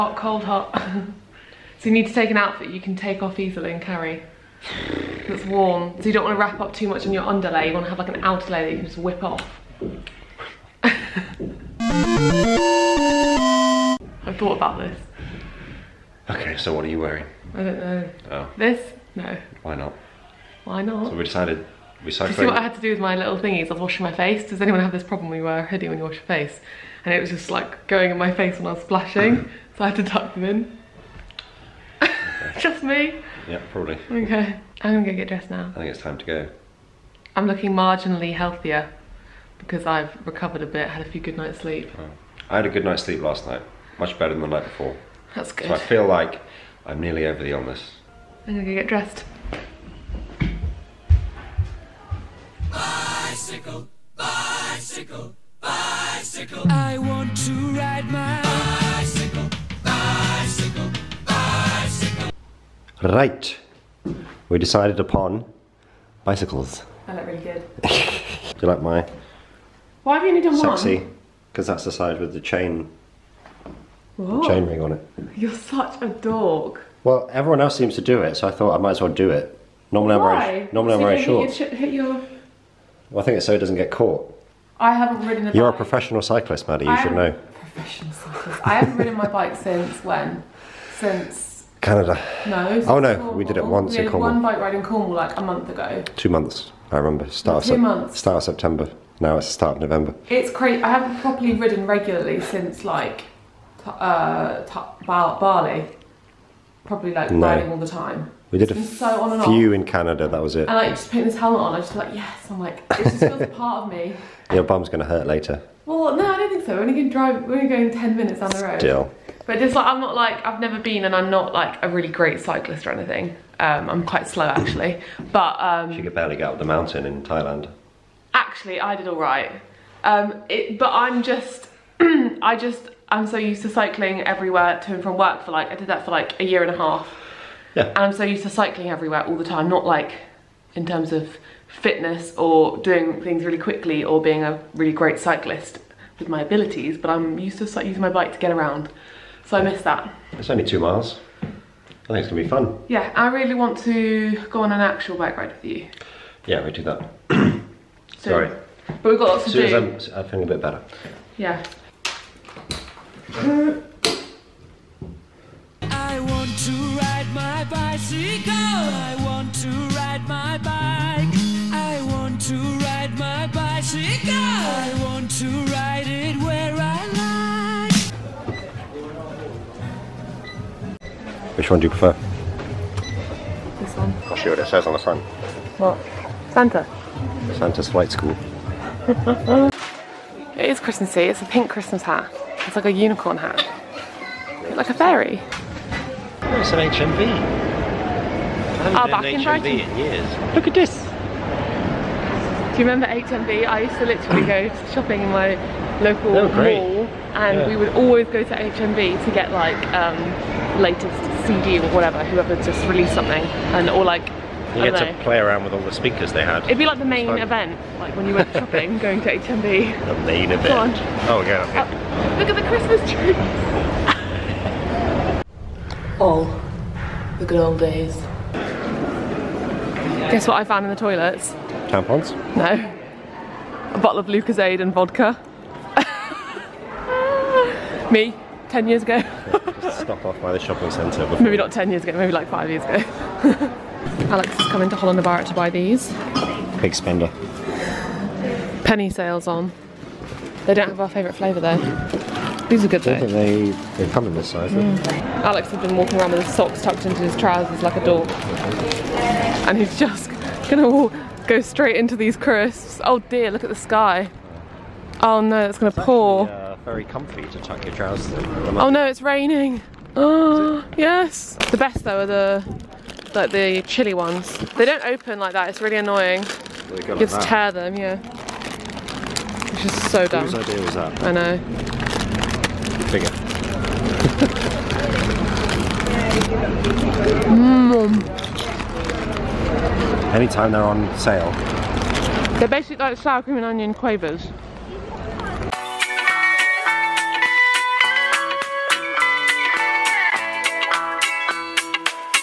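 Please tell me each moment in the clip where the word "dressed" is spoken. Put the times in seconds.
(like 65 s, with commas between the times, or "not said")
35 s, 48 s.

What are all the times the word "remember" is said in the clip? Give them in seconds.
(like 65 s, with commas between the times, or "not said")
96 s, 202 s.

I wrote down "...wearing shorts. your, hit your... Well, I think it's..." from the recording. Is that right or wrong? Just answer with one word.
right.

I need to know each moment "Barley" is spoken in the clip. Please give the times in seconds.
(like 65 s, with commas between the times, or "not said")
105 s.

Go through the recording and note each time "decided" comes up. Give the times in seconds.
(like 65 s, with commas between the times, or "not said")
21 s, 64 s.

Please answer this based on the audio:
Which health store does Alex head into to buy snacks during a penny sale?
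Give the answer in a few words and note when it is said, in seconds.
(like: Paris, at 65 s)
Holland and Barrett, at 244 s.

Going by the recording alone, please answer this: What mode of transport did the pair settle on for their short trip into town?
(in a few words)
Bicycles.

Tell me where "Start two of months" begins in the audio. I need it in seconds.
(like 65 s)
97 s.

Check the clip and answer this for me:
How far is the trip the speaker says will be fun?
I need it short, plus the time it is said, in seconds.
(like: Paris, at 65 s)
2 miles, at 150 s.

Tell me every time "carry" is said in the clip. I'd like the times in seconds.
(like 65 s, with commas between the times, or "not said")
3 s.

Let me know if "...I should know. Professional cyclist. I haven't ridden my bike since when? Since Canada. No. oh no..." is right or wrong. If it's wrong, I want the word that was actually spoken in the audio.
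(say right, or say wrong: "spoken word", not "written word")
right.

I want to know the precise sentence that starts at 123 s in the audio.
Um, I'm quite slow actually, but...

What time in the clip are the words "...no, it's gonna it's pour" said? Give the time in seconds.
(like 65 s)
265 s.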